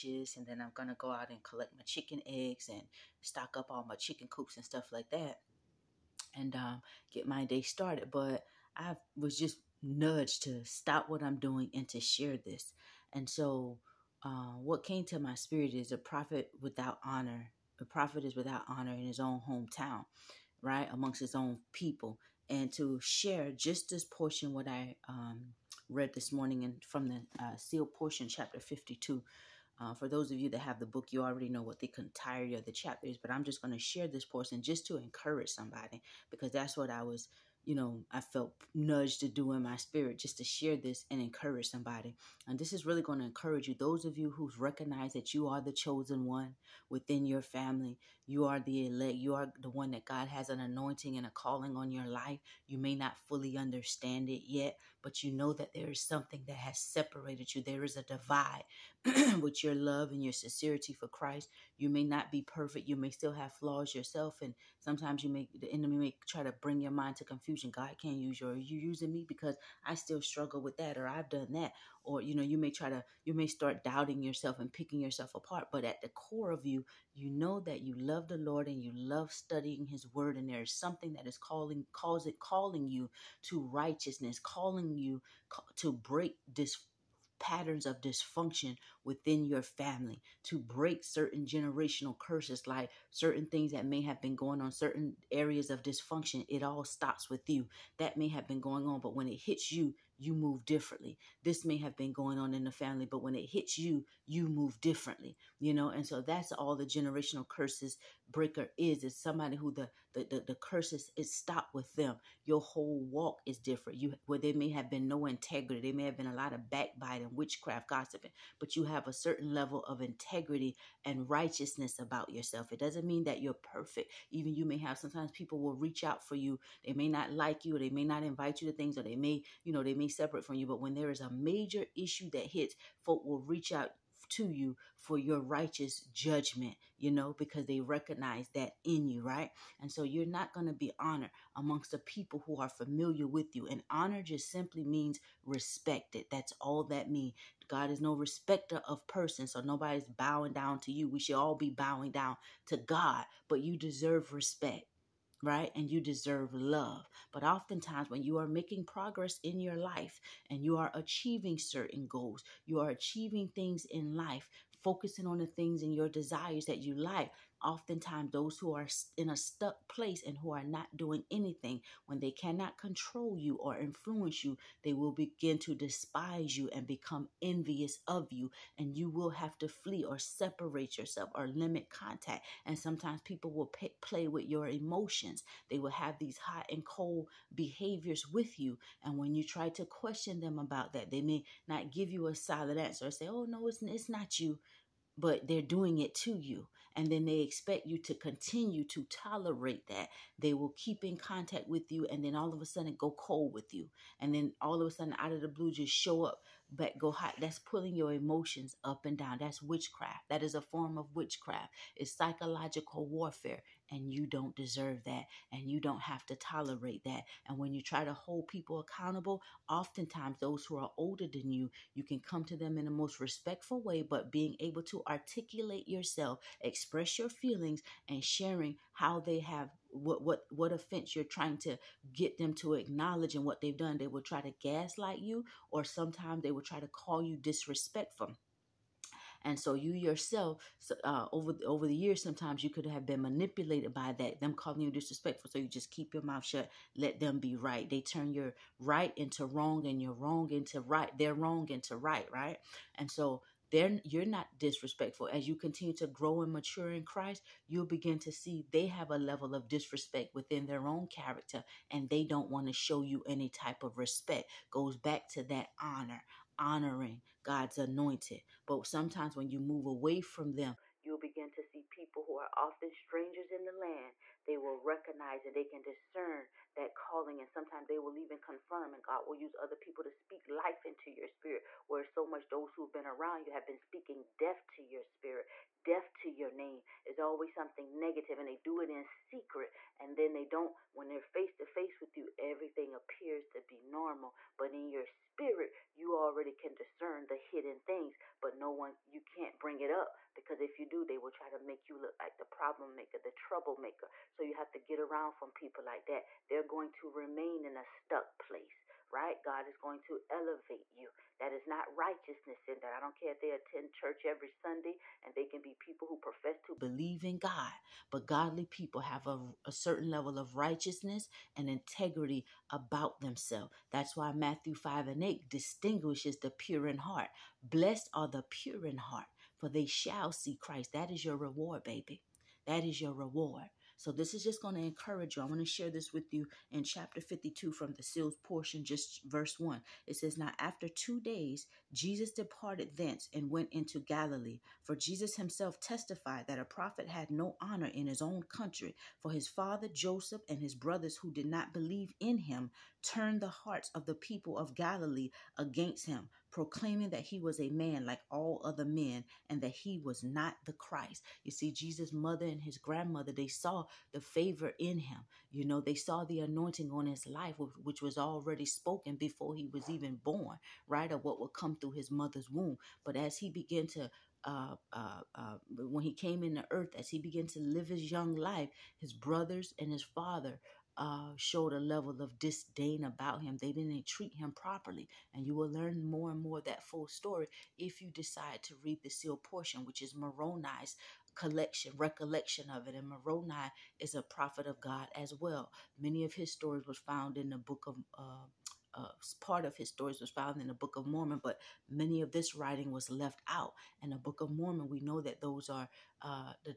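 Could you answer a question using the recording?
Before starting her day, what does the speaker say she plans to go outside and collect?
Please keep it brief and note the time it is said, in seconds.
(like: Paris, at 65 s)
chicken eggs, at 1 s.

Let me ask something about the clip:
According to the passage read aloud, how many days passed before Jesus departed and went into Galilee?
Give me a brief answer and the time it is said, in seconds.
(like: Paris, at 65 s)
2, at 340 s.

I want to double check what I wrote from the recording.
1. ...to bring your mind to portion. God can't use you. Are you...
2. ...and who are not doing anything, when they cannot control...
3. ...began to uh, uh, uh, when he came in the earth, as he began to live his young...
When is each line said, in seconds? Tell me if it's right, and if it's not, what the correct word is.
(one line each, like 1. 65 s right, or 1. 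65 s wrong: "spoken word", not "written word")
1. 66 s wrong: "confusion", not "portion"
2. 170 s right
3. 373 s right.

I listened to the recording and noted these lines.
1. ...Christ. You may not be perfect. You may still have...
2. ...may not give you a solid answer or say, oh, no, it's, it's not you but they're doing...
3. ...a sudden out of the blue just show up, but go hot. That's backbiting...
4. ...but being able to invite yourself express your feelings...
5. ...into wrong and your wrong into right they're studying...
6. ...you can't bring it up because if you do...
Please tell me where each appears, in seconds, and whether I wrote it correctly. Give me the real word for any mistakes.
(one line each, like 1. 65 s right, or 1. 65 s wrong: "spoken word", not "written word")
1. 61 s right
2. 191 s right
3. 204 s wrong: "pulling", not "backbiting"
4. 224 s wrong: "articulate", not "invite"
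5. 249 s wrong: "wrong", not "studying"
6. 299 s right.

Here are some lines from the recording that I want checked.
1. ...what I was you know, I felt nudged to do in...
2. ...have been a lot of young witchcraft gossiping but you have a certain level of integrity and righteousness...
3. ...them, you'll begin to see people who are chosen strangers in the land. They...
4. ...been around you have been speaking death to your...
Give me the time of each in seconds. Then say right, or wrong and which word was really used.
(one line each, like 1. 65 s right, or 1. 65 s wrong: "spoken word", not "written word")
1. 36 s right
2. 116 s wrong: "backbiting", not "young"
3. 270 s wrong: "often", not "chosen"
4. 282 s right.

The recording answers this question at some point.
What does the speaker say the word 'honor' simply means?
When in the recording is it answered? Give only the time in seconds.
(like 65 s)
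145 s.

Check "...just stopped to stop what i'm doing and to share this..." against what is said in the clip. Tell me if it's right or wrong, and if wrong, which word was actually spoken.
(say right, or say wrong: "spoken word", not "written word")
wrong: "nudged", not "stopped".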